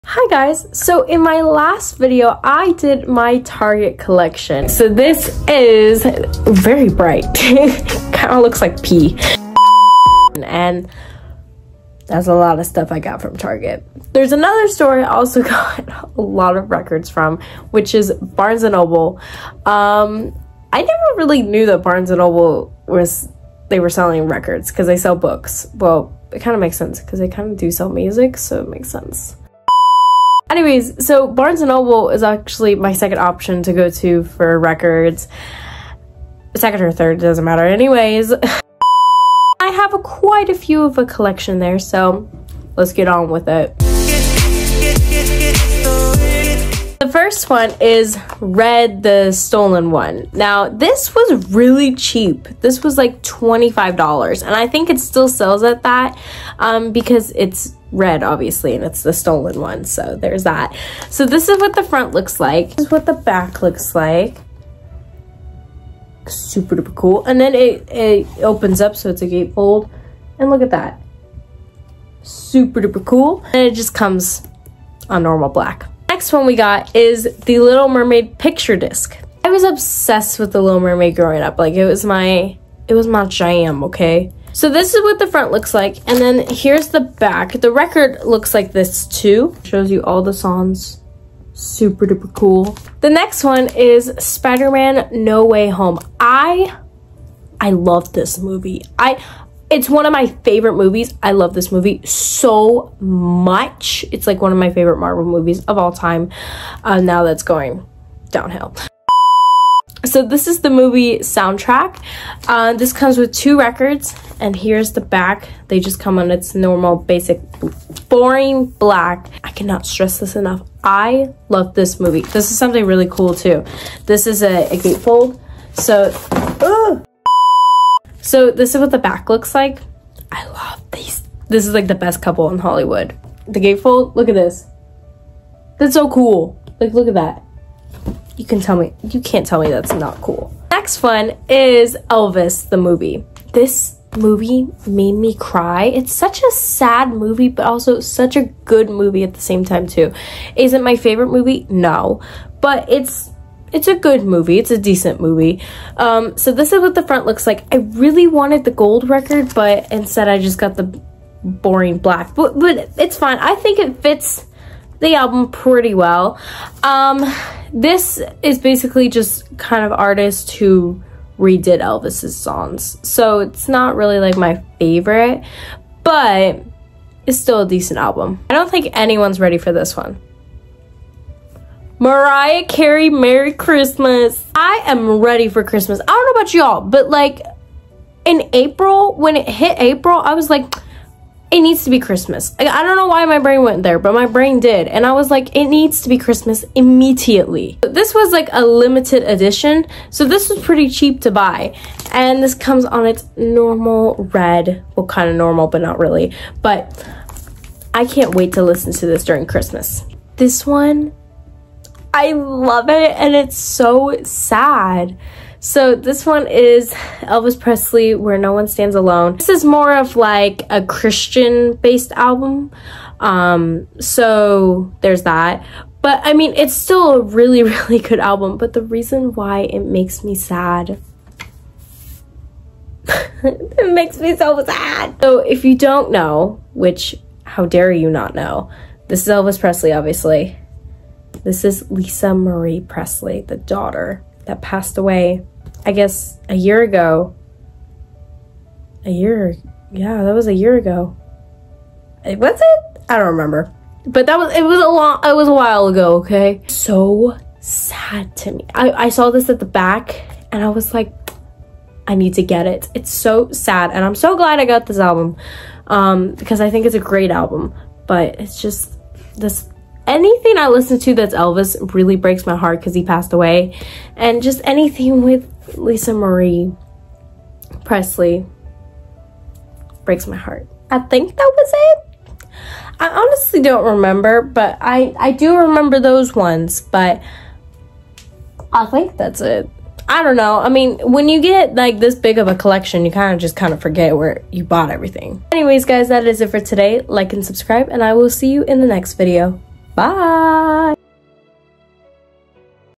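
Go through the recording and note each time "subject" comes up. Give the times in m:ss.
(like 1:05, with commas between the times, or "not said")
not said.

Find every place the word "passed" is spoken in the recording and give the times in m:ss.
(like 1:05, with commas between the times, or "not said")
4:04, 4:33.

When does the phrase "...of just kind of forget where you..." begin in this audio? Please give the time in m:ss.
4:53.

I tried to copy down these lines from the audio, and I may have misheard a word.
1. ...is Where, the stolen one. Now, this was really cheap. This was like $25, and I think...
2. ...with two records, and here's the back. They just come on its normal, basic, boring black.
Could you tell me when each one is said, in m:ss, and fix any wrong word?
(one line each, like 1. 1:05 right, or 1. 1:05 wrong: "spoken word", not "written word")
1. 0:47 wrong: "Red", not "Where"
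2. 1:53 right.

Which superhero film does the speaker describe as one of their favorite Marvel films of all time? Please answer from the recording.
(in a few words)
Spider-Man No Way Home.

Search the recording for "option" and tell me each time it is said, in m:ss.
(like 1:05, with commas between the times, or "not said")
0:33.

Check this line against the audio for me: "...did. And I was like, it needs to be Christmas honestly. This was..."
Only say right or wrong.
wrong.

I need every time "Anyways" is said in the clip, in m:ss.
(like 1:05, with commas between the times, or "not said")
0:30, 0:37, 4:55.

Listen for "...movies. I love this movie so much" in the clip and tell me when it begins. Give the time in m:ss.
1:40.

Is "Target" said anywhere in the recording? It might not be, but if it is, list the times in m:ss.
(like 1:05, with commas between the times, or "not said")
0:03, 0:13.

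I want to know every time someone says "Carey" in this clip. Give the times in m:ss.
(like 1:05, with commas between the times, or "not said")
3:02.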